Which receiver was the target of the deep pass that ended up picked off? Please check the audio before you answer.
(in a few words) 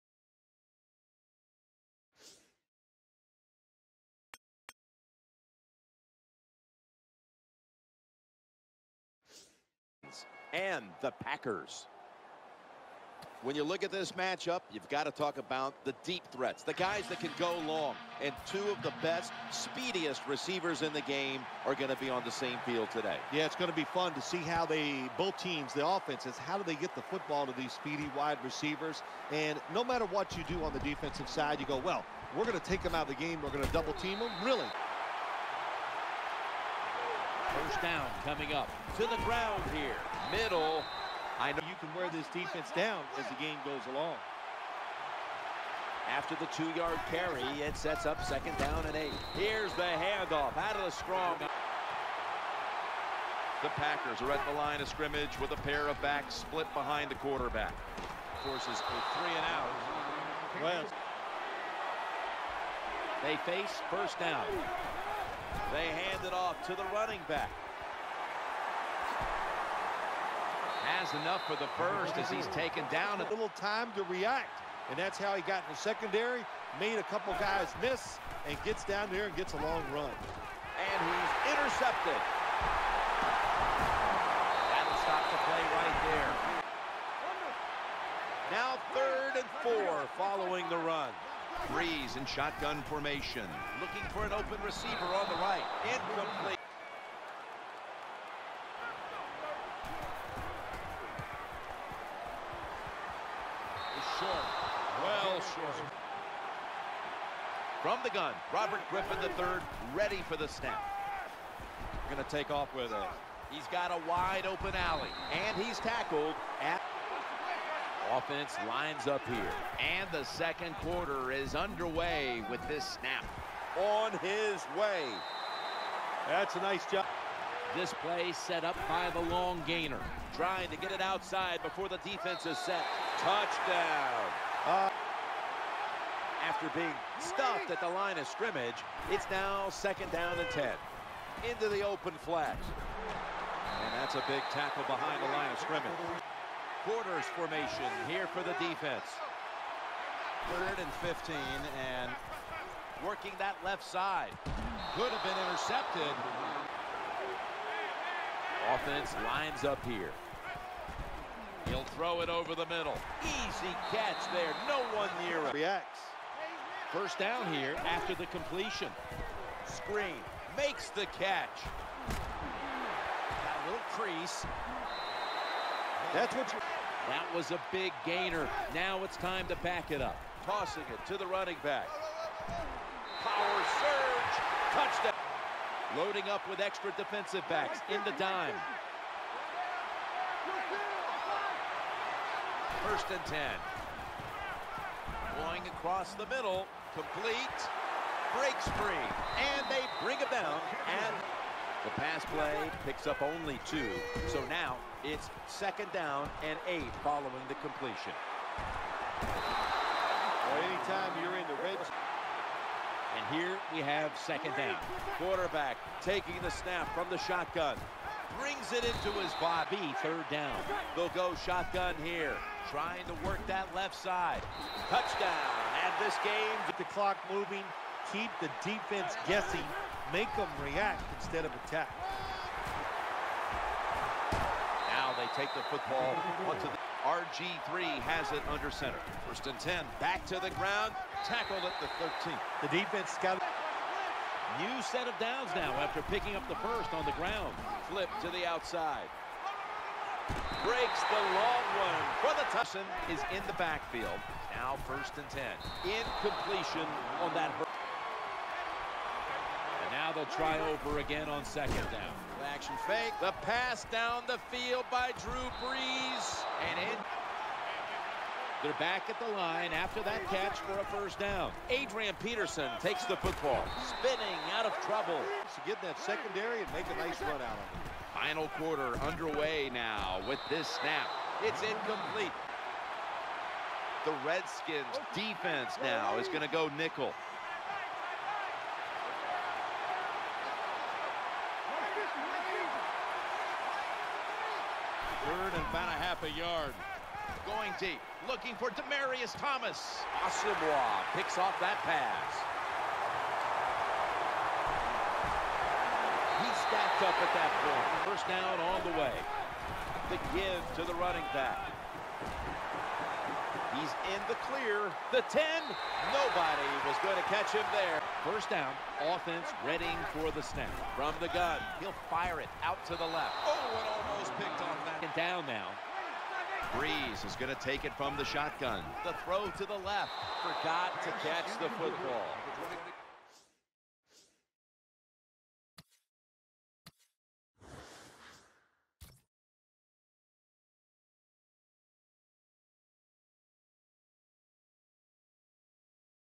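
Demaryius Thomas.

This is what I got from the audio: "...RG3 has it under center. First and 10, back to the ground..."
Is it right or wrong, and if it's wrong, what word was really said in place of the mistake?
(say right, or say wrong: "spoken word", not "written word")
right.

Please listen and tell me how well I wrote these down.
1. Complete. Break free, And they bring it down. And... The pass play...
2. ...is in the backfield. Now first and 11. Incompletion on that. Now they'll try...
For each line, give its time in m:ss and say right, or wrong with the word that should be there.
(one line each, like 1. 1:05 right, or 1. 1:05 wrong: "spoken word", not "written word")
1. 3:16 right
2. 4:13 wrong: "10", not "11".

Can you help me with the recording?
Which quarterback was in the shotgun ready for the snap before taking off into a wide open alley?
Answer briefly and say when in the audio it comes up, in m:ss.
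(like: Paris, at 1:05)
Robert Griffin III, at 1:48.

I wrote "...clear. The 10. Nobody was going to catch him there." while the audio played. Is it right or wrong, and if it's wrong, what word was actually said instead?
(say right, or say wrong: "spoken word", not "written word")
right.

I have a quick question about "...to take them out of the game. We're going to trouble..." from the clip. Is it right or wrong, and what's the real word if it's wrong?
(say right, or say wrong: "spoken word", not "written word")
wrong: "double", not "trouble".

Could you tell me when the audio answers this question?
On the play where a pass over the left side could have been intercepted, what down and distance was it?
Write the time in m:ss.
2:30.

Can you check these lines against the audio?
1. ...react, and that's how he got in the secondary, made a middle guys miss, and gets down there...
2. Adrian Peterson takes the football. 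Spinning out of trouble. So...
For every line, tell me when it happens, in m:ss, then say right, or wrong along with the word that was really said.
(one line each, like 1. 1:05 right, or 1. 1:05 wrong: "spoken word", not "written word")
1. 1:14 wrong: "couple", not "middle"
2. 4:31 right.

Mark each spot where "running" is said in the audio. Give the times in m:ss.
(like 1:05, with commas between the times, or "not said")
1:06, 3:01, 5:10.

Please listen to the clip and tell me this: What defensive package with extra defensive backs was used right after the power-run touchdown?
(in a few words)
dime.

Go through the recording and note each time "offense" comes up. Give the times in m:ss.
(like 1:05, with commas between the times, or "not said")
0:25, 1:58, 2:38, 5:19.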